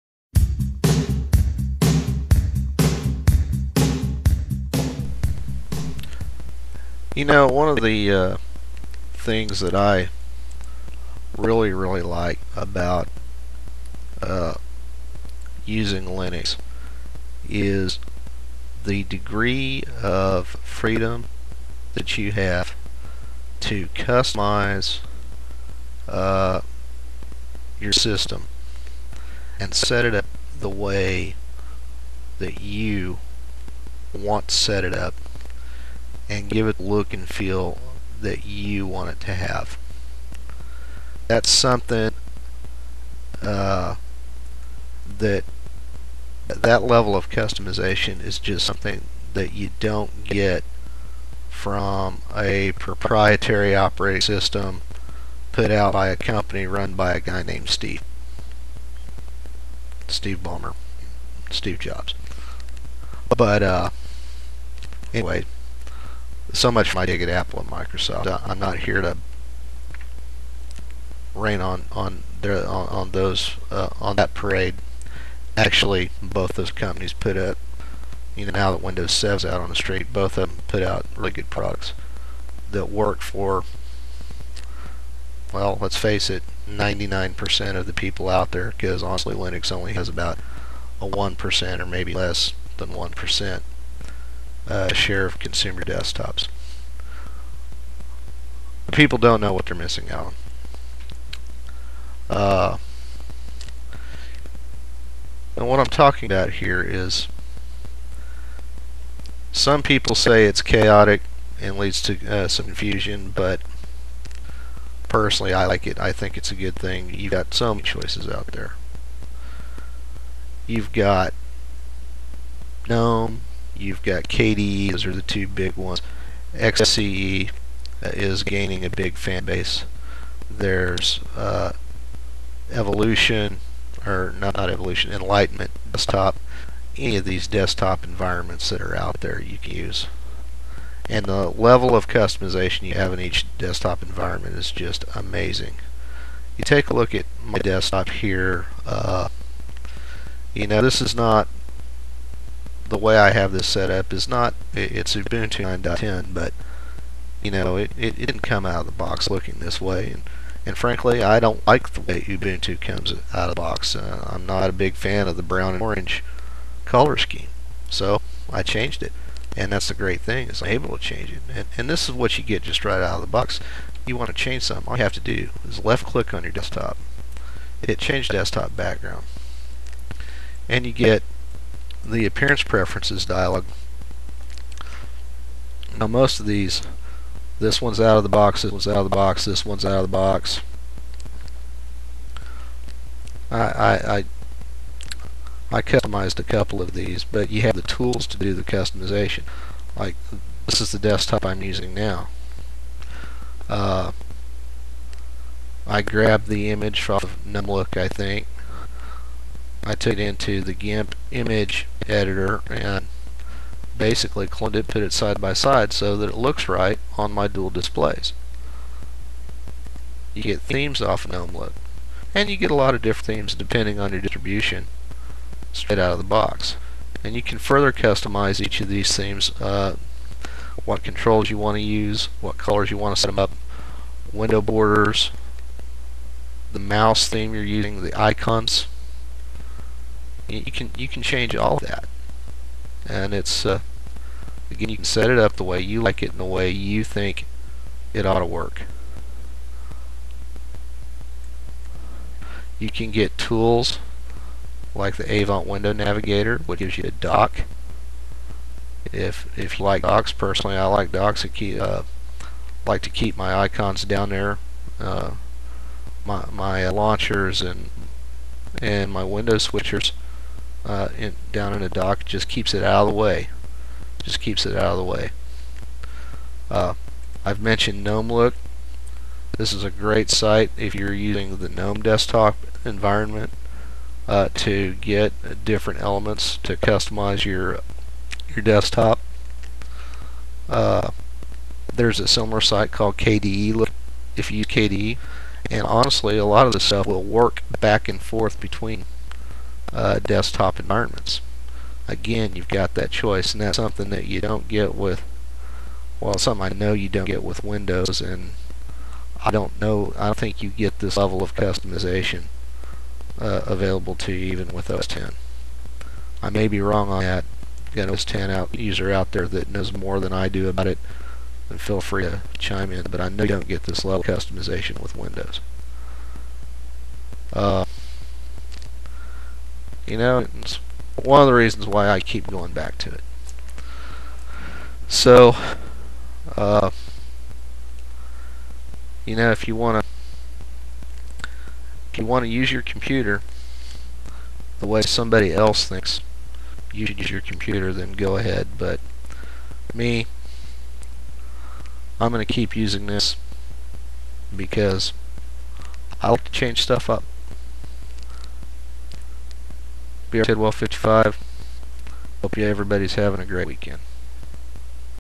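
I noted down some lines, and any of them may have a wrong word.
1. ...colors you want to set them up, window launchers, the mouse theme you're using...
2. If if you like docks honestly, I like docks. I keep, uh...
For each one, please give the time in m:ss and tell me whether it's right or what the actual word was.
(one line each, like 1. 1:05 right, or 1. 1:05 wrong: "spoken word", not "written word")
1. 3:52 wrong: "borders", not "launchers"
2. 4:19 wrong: "personally", not "honestly".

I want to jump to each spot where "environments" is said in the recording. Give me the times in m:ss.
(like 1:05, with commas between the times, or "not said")
2:18, 2:24, 4:42, 5:00.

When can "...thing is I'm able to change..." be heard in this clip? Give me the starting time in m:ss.
2:50.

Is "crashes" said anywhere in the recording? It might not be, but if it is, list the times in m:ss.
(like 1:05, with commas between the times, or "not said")
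not said.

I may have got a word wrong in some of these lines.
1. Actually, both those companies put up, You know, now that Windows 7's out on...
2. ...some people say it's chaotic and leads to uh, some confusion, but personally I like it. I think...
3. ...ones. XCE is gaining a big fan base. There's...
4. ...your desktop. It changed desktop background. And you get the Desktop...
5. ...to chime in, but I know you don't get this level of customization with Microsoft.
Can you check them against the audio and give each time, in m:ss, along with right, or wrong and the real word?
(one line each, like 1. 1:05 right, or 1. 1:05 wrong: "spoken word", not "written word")
1. 1:15 right
2. 1:49 right
3. 2:05 right
4. 2:56 wrong: "Appearance", not "Desktop"
5. 5:22 wrong: "Windows", not "Microsoft".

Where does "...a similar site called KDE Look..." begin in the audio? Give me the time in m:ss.
4:52.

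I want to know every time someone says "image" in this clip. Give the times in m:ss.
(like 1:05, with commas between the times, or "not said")
3:26, 3:31.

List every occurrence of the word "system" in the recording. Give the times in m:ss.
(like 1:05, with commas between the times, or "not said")
0:27, 0:54.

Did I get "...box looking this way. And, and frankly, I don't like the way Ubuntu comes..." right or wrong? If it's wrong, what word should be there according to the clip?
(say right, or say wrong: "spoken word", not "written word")
right.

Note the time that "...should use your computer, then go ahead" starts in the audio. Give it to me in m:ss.
5:47.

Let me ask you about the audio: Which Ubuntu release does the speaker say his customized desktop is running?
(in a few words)
9.10.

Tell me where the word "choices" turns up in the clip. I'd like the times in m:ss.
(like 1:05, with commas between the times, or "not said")
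1:57, 5:03.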